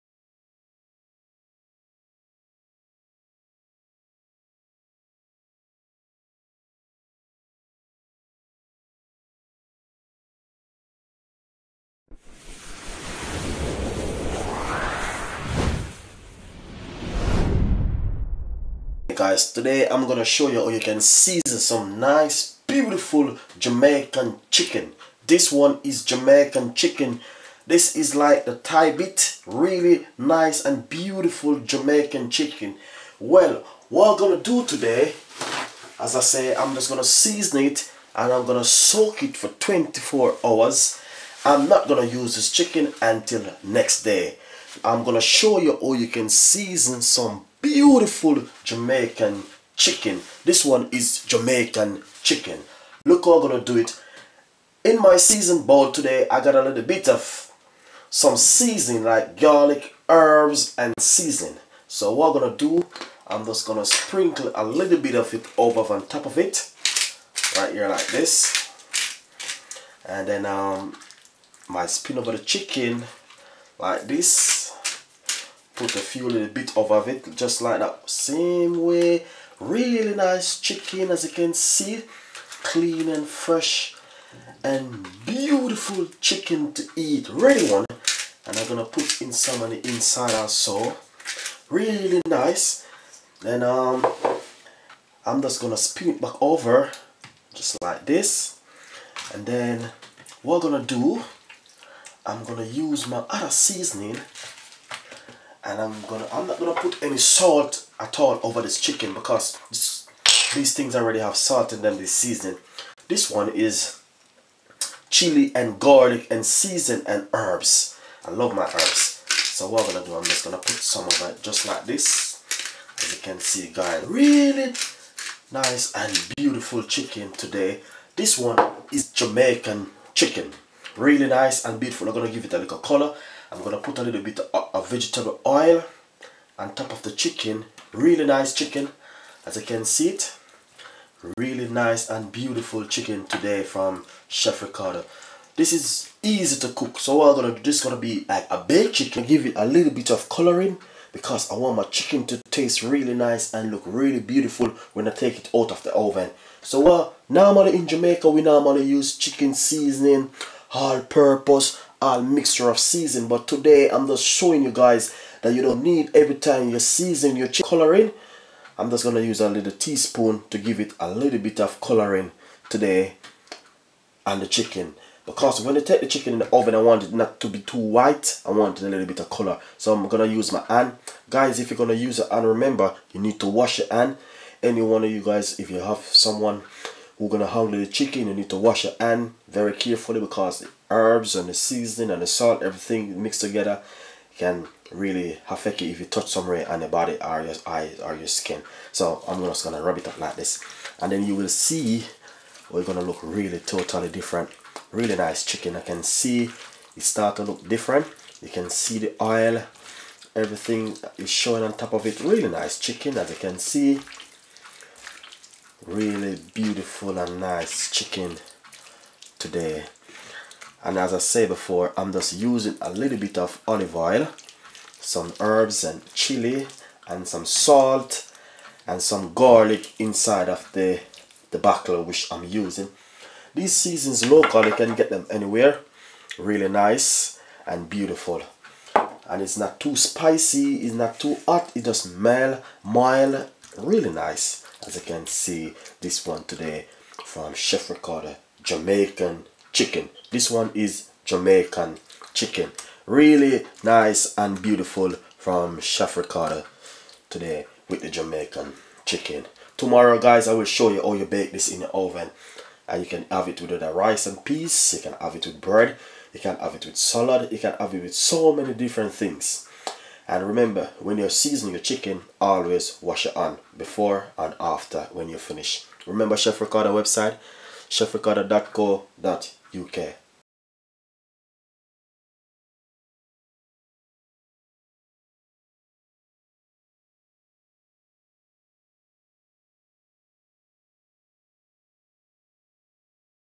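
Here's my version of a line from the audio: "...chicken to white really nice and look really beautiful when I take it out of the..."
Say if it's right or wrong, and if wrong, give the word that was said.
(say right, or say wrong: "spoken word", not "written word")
wrong: "taste", not "white".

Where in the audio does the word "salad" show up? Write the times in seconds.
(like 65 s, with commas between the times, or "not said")
266 s.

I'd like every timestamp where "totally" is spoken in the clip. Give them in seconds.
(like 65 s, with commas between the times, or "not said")
203 s.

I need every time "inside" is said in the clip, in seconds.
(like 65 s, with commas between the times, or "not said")
89 s, 229 s.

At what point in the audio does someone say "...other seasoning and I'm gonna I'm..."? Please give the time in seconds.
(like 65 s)
103 s.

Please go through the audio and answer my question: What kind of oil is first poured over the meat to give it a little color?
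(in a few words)
vegetable oil.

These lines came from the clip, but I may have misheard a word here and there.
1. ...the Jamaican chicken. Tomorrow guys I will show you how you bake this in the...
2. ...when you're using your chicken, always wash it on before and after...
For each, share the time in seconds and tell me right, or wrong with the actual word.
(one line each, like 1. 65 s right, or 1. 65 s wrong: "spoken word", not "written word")
1. 258 s right
2. 270 s wrong: "seasoning", not "using".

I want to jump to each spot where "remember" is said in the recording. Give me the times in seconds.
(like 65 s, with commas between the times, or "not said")
182 s, 270 s, 276 s.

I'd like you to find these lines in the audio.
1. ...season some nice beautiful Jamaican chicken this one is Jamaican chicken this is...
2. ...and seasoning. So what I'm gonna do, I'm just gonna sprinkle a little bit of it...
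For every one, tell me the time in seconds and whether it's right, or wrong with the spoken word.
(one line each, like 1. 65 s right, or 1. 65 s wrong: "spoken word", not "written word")
1. 21 s right
2. 60 s right.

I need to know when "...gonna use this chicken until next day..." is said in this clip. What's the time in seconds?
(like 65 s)
41 s.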